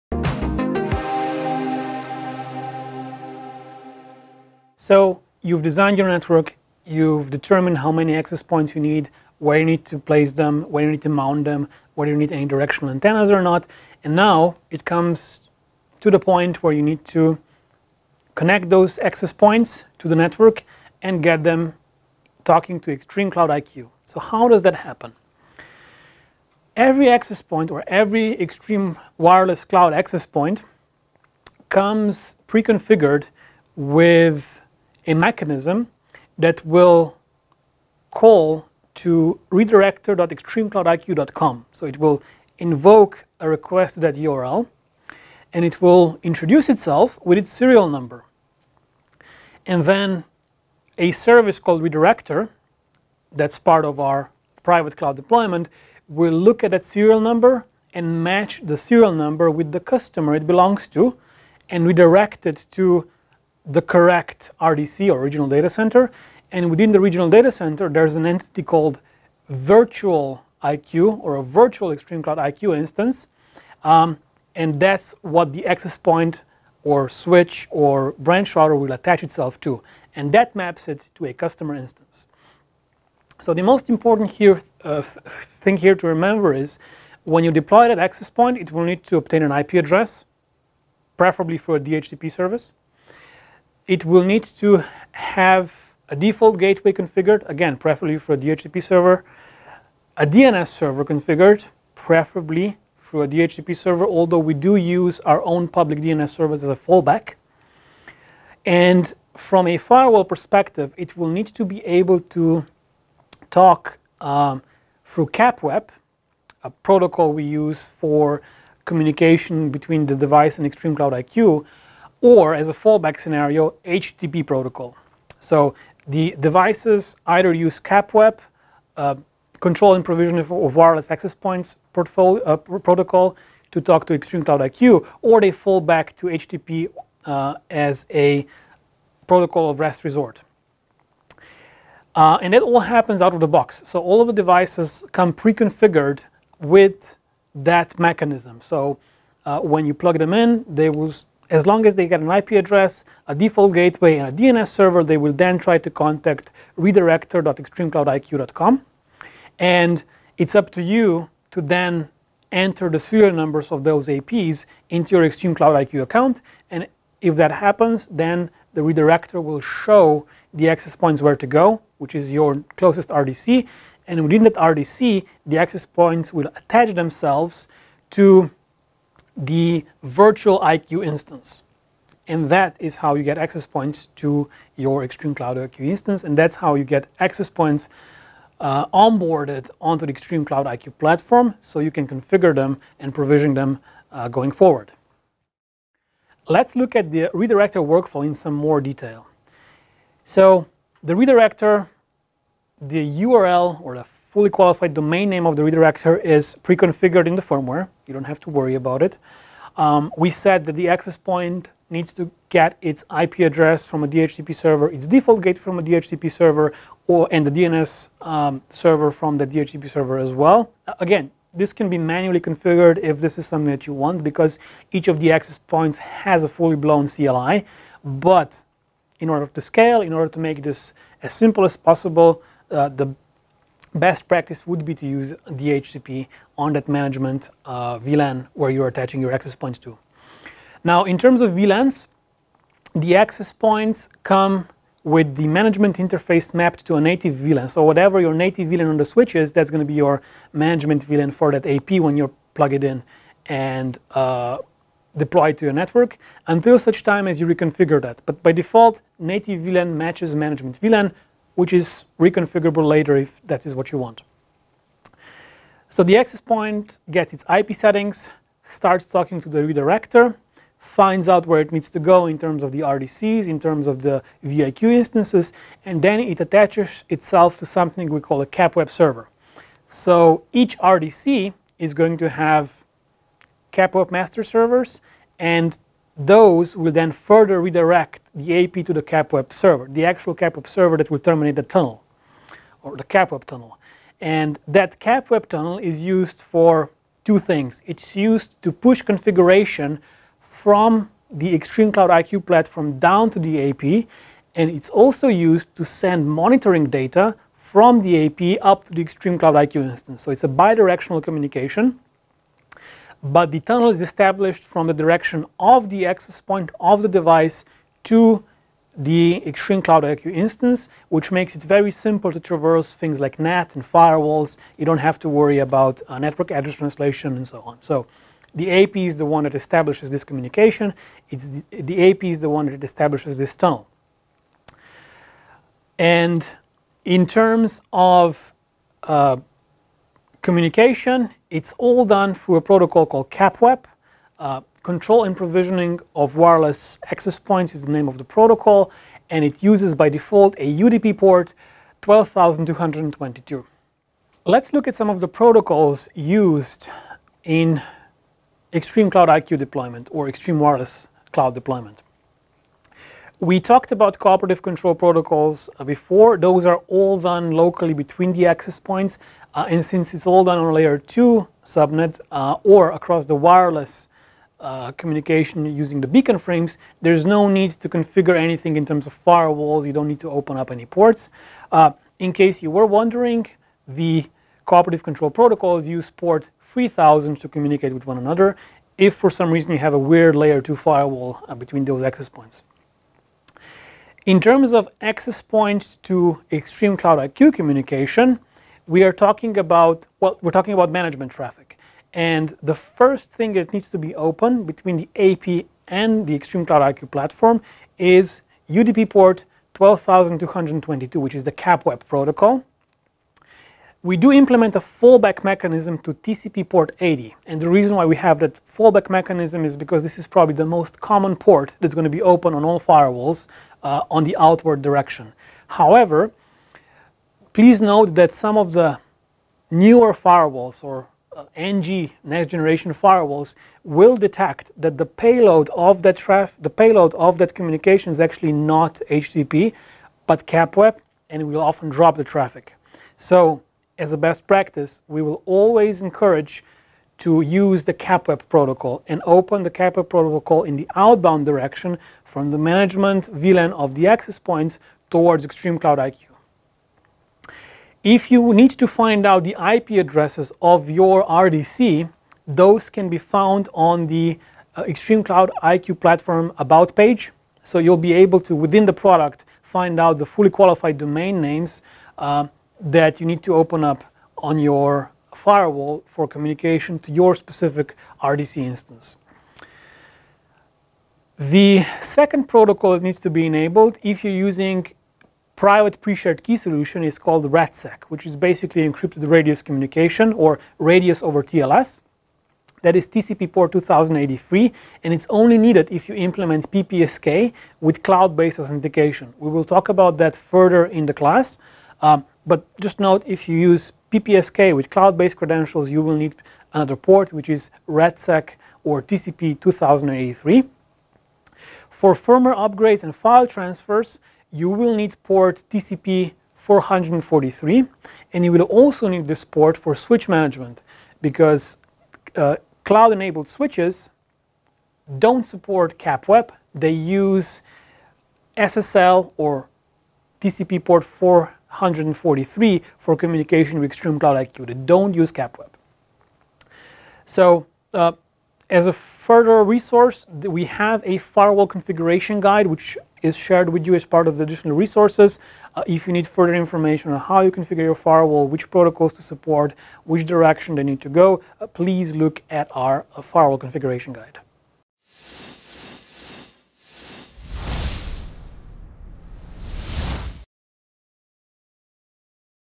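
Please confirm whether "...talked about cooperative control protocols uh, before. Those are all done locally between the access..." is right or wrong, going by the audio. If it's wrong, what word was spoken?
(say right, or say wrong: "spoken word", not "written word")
right.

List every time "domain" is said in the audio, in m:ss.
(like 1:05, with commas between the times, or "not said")
3:24, 7:50.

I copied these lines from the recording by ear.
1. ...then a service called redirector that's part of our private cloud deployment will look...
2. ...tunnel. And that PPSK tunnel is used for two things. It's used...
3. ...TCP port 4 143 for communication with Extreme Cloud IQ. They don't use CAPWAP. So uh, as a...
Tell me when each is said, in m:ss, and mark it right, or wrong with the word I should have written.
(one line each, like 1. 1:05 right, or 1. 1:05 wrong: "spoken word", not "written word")
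1. 0:49 right
2. 4:53 wrong: "CAPWAP", not "PPSK"
3. 8:50 right.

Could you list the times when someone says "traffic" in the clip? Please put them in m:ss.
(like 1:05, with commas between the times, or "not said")
6:41, 7:16, 7:22.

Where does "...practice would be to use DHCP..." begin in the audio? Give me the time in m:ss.
3:54.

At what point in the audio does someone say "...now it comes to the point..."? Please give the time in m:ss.
0:14.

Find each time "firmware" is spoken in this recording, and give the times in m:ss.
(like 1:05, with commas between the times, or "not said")
3:27, 8:32.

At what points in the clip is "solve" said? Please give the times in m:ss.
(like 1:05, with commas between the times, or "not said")
not said.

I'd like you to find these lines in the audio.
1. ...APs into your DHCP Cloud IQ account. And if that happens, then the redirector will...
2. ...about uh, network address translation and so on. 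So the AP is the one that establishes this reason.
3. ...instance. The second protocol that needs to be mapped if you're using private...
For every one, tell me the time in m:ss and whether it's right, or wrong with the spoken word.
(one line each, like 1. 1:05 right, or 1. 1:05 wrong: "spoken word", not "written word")
1. 2:44 wrong: "Extreme", not "DHCP"
2. 5:25 wrong: "communication", not "reason"
3. 7:58 wrong: "enabled", not "mapped".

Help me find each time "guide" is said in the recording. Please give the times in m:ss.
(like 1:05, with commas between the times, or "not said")
9:02, 9:14.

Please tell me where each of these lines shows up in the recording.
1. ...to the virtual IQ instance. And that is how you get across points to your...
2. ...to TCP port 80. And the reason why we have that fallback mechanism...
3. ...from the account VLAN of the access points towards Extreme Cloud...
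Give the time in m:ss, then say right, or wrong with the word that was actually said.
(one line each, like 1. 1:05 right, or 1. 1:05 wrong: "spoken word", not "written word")
1. 2:58 wrong: "access", not "across"
2. 6:55 right
3. 7:32 wrong: "management", not "account".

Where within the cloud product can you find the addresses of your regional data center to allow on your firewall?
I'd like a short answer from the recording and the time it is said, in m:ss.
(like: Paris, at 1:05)
about page, at 7:46.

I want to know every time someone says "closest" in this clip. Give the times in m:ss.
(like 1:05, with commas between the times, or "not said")
2:52.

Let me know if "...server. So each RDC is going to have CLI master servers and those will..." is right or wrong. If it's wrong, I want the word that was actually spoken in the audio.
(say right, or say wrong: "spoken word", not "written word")
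wrong: "CAPWAP", not "CLI".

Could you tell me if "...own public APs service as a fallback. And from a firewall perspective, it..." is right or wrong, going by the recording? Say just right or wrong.
wrong.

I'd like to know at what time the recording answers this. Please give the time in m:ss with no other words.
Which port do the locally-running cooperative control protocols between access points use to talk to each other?
6:26.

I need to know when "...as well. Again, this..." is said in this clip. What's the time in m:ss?
3:40.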